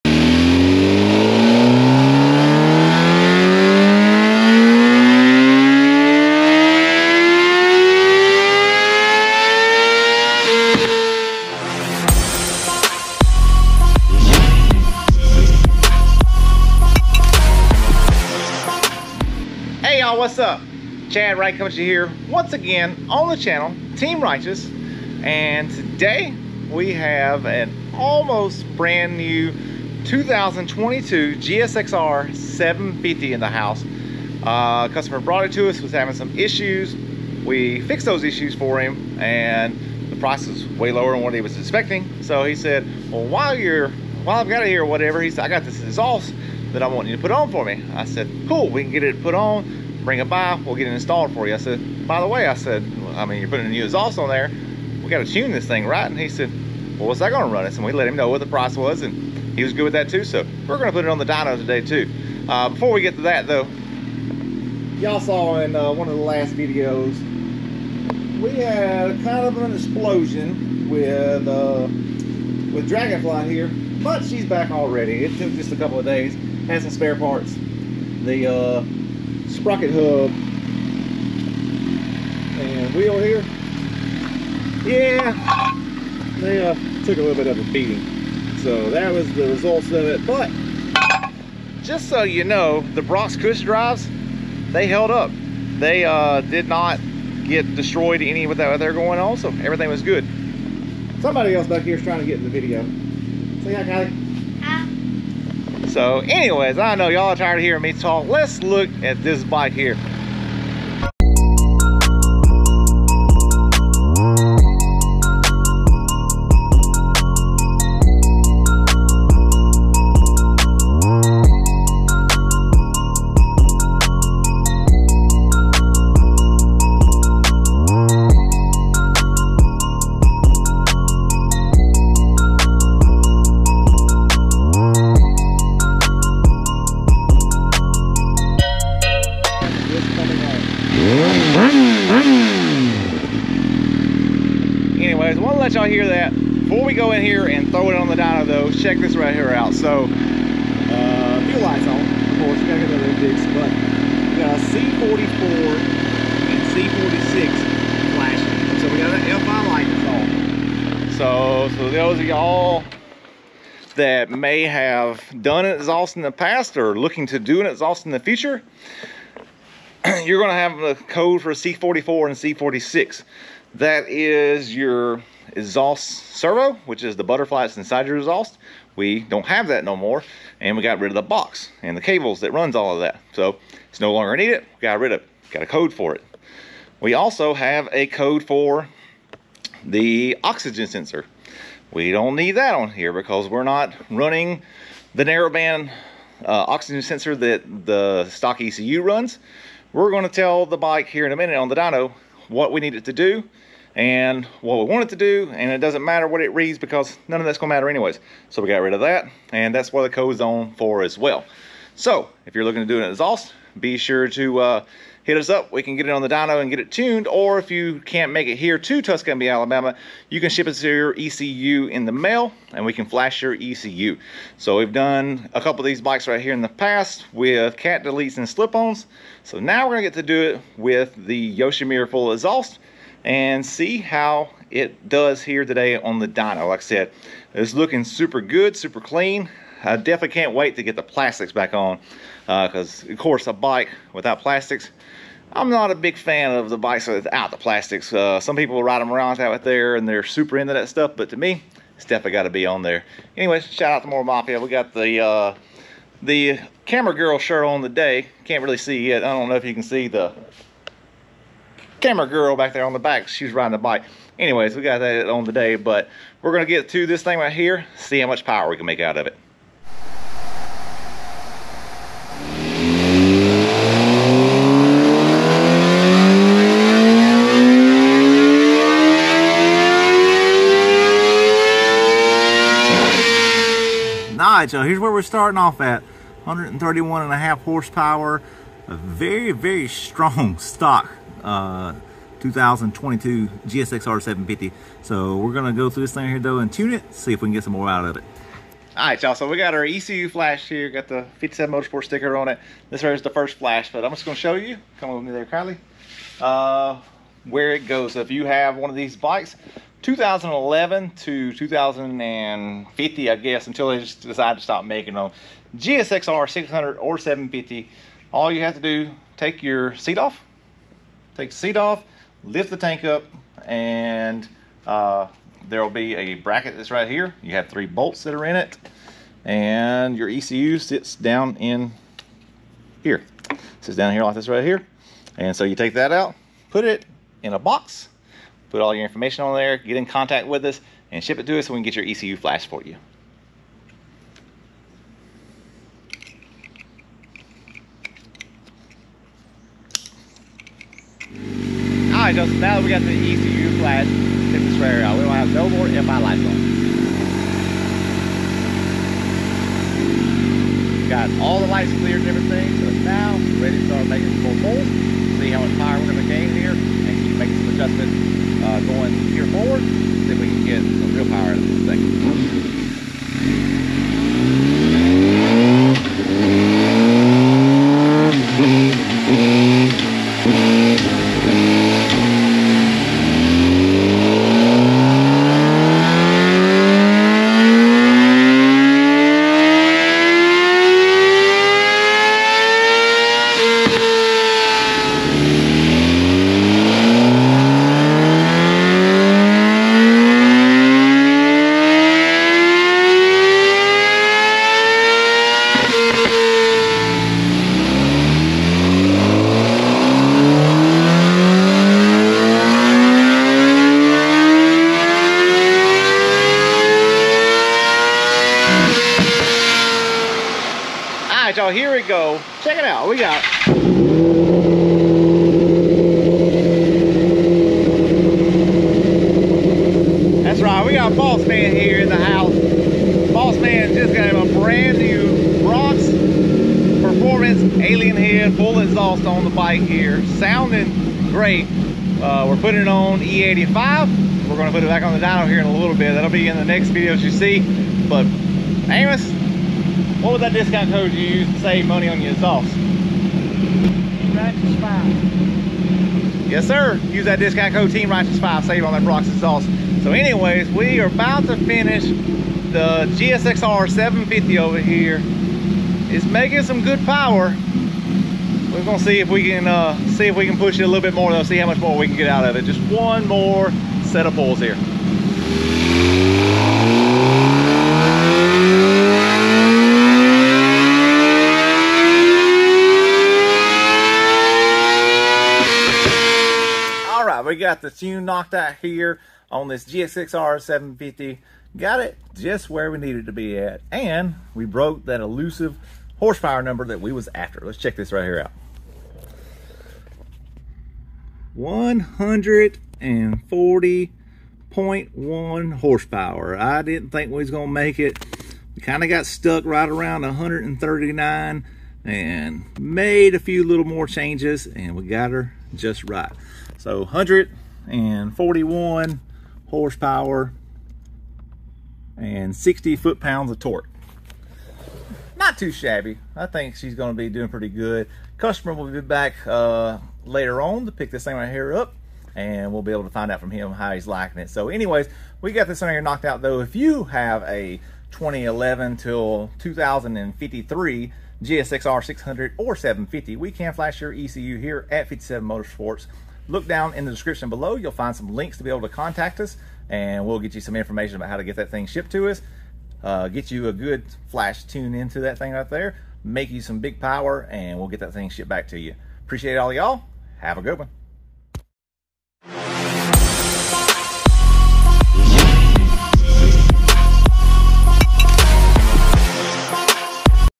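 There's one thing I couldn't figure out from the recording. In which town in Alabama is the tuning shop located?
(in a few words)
Tuscumbia.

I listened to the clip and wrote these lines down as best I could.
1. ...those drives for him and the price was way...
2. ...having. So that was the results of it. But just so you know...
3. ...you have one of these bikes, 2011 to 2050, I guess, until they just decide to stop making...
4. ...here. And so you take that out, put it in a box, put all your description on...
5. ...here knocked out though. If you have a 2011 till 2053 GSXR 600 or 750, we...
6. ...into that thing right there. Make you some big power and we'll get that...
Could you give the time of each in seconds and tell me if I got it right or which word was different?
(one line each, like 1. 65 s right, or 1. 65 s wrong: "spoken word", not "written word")
1. 38 s wrong: "issues", not "drives"
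2. 87 s wrong: "beating", not "having"
3. 308 s right
4. 334 s wrong: "information", not "description"
5. 535 s right
6. 554 s right.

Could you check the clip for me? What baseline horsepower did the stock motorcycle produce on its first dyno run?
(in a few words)
131.5.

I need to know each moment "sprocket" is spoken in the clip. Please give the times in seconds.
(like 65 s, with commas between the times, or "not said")
79 s.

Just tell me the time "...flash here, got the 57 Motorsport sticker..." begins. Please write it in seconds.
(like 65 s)
300 s.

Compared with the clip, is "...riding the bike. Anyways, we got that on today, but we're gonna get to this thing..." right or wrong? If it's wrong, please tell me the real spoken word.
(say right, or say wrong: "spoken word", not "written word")
right.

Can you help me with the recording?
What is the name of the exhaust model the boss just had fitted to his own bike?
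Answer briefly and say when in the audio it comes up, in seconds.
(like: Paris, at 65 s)
Alien Head, at 437 s.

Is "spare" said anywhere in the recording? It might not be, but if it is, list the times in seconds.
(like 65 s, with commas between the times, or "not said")
76 s.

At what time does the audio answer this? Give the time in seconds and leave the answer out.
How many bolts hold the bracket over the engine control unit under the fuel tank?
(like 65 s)
327 s.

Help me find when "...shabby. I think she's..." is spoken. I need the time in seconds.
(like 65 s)
525 s.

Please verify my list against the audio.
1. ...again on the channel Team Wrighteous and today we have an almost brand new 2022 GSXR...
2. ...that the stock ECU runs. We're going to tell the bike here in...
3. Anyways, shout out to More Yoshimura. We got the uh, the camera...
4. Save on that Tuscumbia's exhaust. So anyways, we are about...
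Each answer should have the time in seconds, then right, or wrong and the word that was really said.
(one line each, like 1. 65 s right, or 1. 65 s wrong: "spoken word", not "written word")
1. 22 s right
2. 197 s right
3. 253 s wrong: "Mafia", not "Yoshimura"
4. 458 s wrong: "Brock", not "Tuscumbia".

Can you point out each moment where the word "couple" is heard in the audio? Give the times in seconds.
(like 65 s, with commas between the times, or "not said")
75 s, 225 s.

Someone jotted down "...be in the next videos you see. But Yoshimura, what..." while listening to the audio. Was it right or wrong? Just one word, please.
wrong.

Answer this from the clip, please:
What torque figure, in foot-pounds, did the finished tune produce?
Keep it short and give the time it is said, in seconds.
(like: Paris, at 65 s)
60, at 522 s.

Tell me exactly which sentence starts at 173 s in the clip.
That is your exhaust servo, which is the butterfly that's inside your exhaust.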